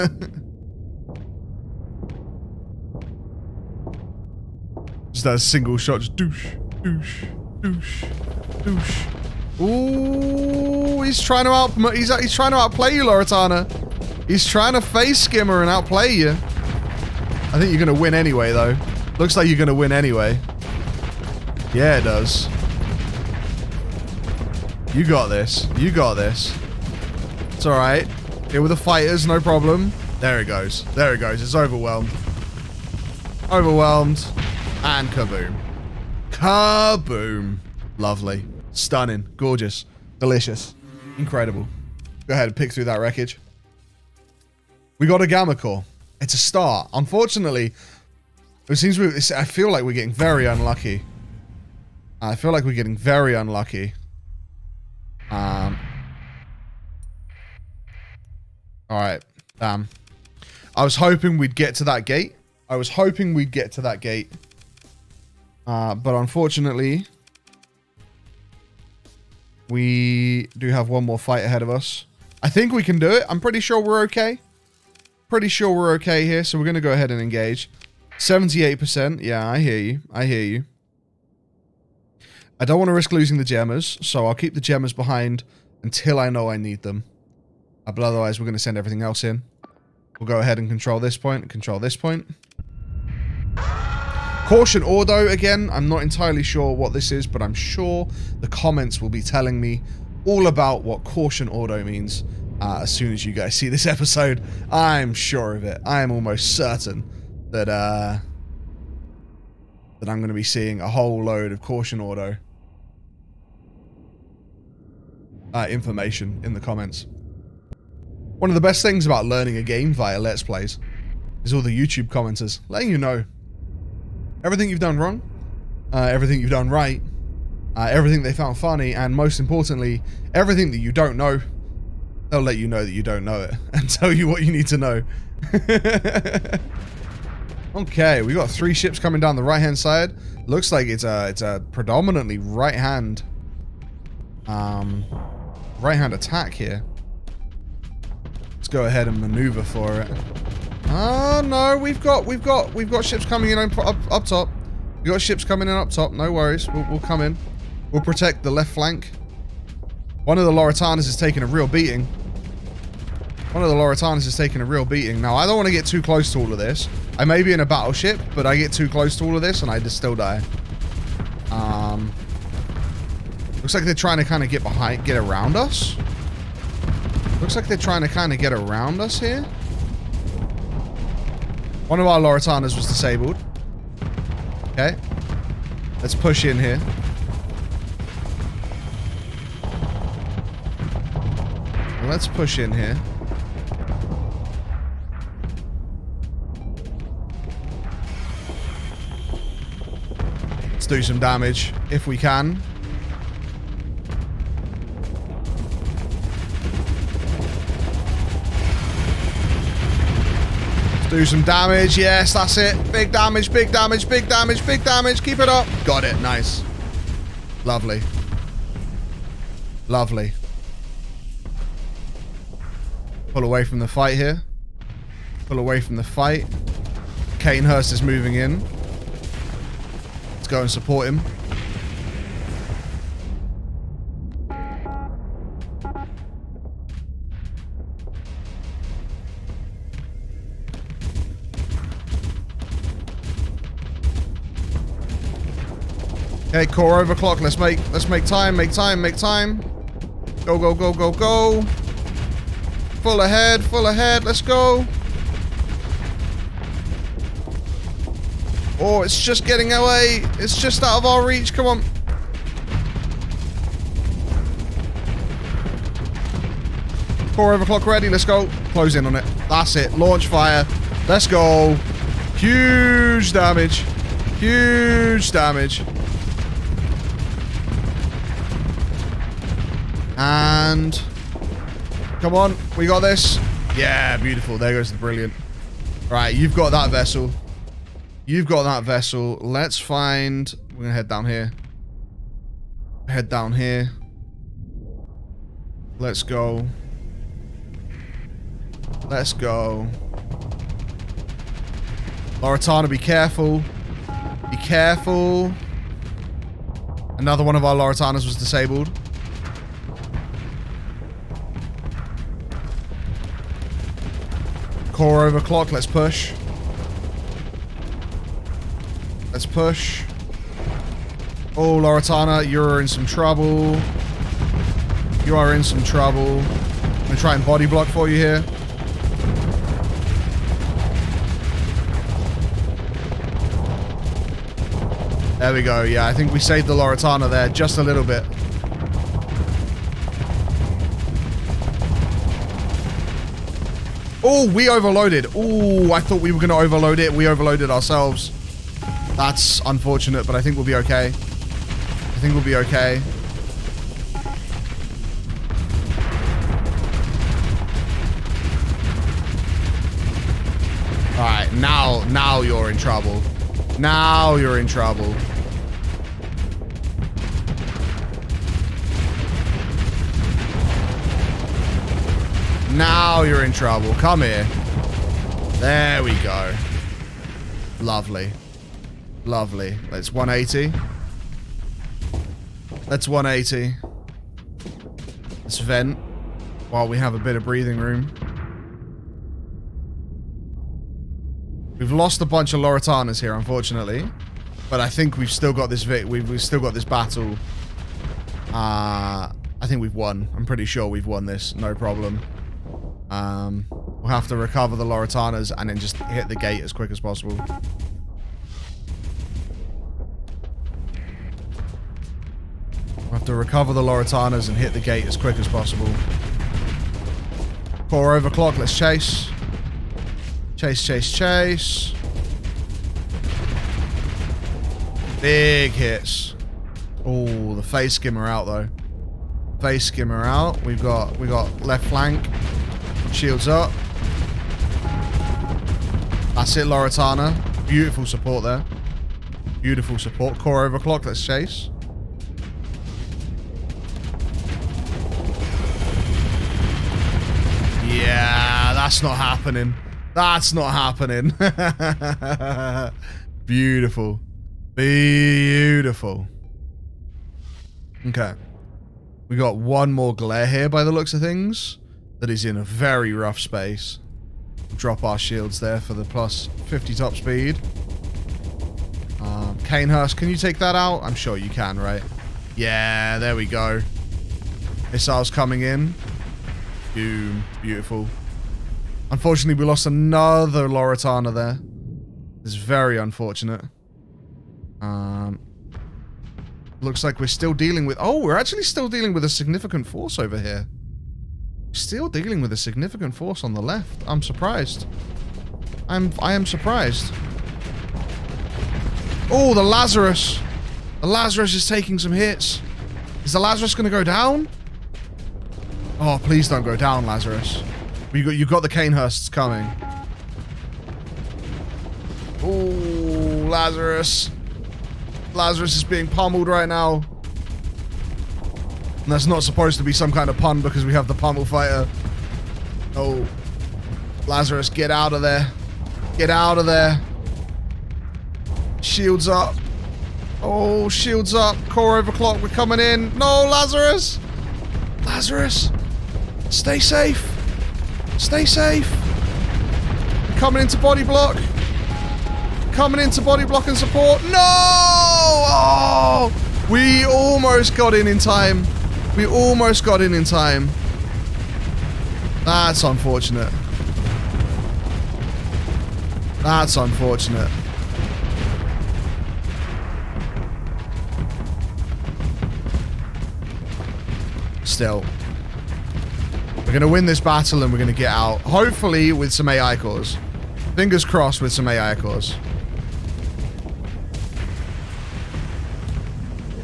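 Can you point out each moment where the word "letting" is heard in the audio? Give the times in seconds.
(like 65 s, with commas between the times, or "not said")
122 s.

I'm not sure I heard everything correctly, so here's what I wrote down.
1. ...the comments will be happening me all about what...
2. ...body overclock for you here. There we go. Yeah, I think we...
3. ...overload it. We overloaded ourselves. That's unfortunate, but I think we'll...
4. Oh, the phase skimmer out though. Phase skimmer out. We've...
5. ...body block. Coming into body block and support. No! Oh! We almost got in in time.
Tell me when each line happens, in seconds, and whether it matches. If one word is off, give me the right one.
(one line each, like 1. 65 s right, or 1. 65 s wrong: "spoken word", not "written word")
1. 98 s wrong: "telling", not "happening"
2. 327 s wrong: "block", not "overclock"
3. 346 s right
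4. 427 s right
5. 540 s right.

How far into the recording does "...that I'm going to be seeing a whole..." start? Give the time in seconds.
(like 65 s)
109 s.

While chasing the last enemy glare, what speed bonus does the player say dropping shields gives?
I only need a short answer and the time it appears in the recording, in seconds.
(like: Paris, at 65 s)
+50 top speed, at 466 s.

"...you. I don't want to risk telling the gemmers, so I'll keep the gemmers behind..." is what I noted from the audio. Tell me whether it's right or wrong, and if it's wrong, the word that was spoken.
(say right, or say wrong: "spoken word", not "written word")
wrong: "losing", not "telling".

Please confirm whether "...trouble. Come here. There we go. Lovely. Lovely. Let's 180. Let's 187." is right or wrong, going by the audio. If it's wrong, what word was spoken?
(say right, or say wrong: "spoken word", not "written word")
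wrong: "180", not "187".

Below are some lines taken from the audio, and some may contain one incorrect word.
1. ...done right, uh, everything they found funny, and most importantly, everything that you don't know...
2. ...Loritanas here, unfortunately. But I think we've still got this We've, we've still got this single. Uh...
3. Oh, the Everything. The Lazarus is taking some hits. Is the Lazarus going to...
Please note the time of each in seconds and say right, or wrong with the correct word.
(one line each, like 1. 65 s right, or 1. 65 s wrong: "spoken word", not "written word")
1. 126 s right
2. 392 s wrong: "battle", not "single"
3. 499 s wrong: "Lazarus", not "Everything".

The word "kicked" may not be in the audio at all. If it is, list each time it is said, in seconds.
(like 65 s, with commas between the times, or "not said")
not said.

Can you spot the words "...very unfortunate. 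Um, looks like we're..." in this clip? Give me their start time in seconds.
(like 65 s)
482 s.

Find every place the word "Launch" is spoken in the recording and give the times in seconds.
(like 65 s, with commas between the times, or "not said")
269 s.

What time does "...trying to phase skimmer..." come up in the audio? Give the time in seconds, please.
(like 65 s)
14 s.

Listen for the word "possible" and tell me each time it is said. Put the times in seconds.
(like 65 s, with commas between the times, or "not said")
406 s, 415 s.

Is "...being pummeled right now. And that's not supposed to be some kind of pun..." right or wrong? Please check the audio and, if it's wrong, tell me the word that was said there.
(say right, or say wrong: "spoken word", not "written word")
right.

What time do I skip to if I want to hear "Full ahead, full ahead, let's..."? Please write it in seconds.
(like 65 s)
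253 s.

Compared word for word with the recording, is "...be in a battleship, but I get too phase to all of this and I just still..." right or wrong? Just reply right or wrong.
wrong.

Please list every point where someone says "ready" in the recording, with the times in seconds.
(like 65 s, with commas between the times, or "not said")
267 s.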